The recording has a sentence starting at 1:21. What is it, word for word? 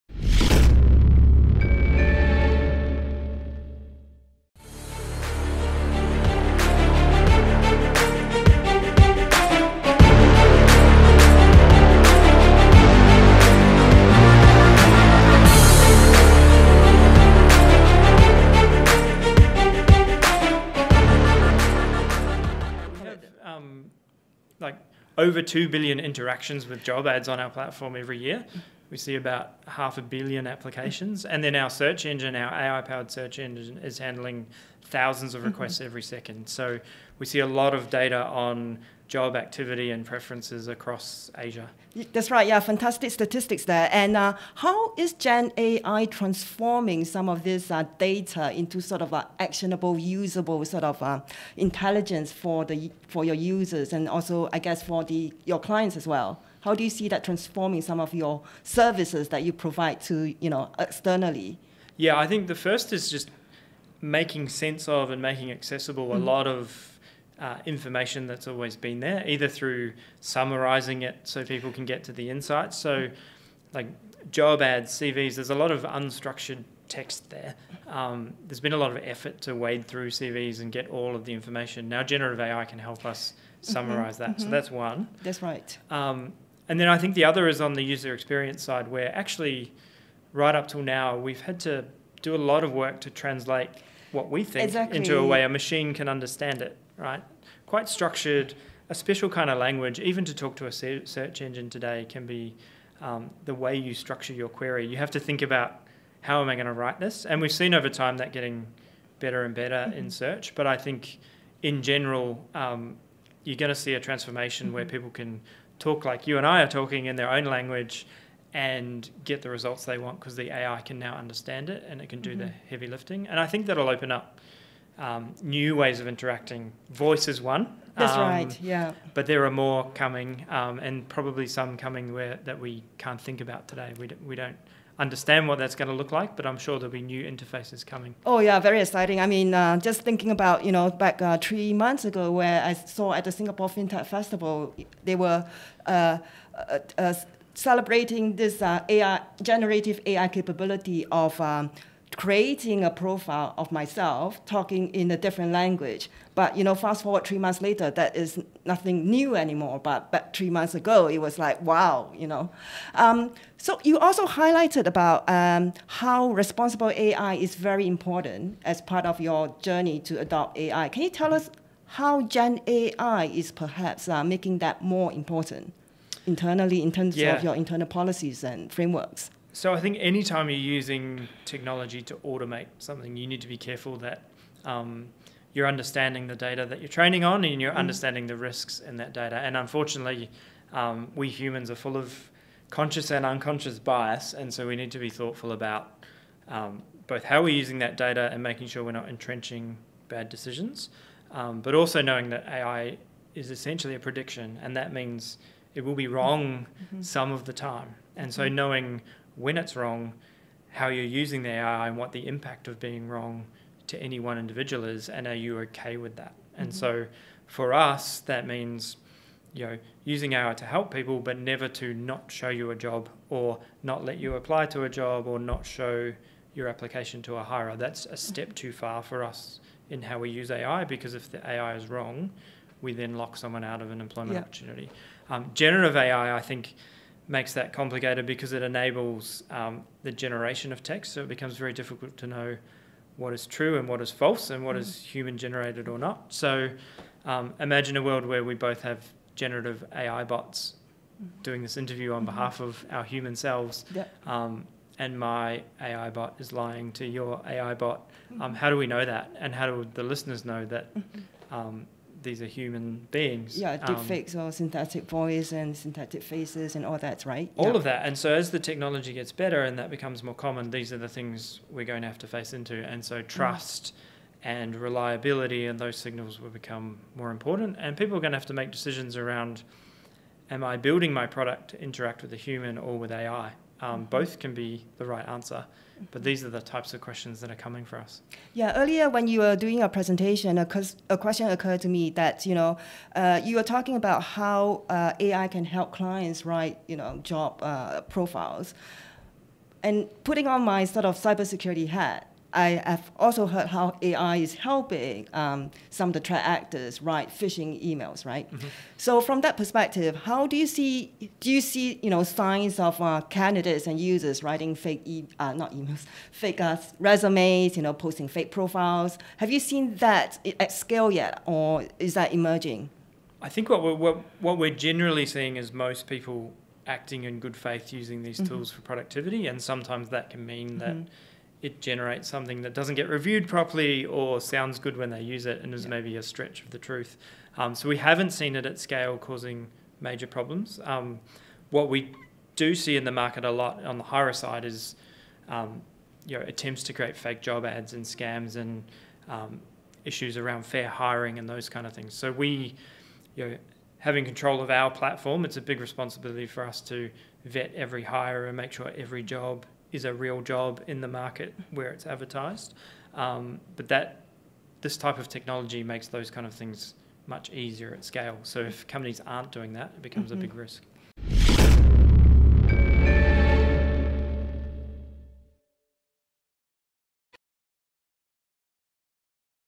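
Now, generative AI can help us mm-hmm, summarize mm-hmm, that.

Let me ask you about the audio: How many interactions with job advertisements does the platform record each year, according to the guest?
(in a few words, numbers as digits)
over 2 billion.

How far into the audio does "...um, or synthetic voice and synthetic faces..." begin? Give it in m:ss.
4:24.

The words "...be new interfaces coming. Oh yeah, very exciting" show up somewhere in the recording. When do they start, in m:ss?
2:16.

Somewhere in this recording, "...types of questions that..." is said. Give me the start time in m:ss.
4:46.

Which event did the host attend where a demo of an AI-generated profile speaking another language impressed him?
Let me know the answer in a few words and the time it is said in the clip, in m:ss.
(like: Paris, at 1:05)
Singapore FinTech Festival, at 2:23.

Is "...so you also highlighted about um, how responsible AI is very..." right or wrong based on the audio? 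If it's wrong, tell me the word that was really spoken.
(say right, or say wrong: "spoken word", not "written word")
right.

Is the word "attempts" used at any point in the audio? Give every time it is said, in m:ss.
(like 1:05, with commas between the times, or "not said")
5:46.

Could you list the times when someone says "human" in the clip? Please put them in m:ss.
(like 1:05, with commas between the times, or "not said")
3:11, 4:05, 4:13, 4:22, 4:42.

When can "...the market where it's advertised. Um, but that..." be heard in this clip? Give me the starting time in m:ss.
6:01.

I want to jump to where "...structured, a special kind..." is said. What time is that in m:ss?
1:37.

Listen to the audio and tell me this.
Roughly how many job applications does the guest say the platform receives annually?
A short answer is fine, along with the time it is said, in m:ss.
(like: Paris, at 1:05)
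half a billion, at 0:29.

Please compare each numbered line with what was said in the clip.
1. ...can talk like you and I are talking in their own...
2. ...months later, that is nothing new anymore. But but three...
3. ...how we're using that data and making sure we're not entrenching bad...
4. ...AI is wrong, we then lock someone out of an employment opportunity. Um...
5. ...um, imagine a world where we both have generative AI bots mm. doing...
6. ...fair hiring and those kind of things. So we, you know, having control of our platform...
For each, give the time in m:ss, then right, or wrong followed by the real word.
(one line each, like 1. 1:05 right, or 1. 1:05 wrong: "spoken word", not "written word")
1. 1:55 right
2. 2:37 right
3. 3:17 right
4. 3:51 right
5. 4:07 right
6. 5:50 right.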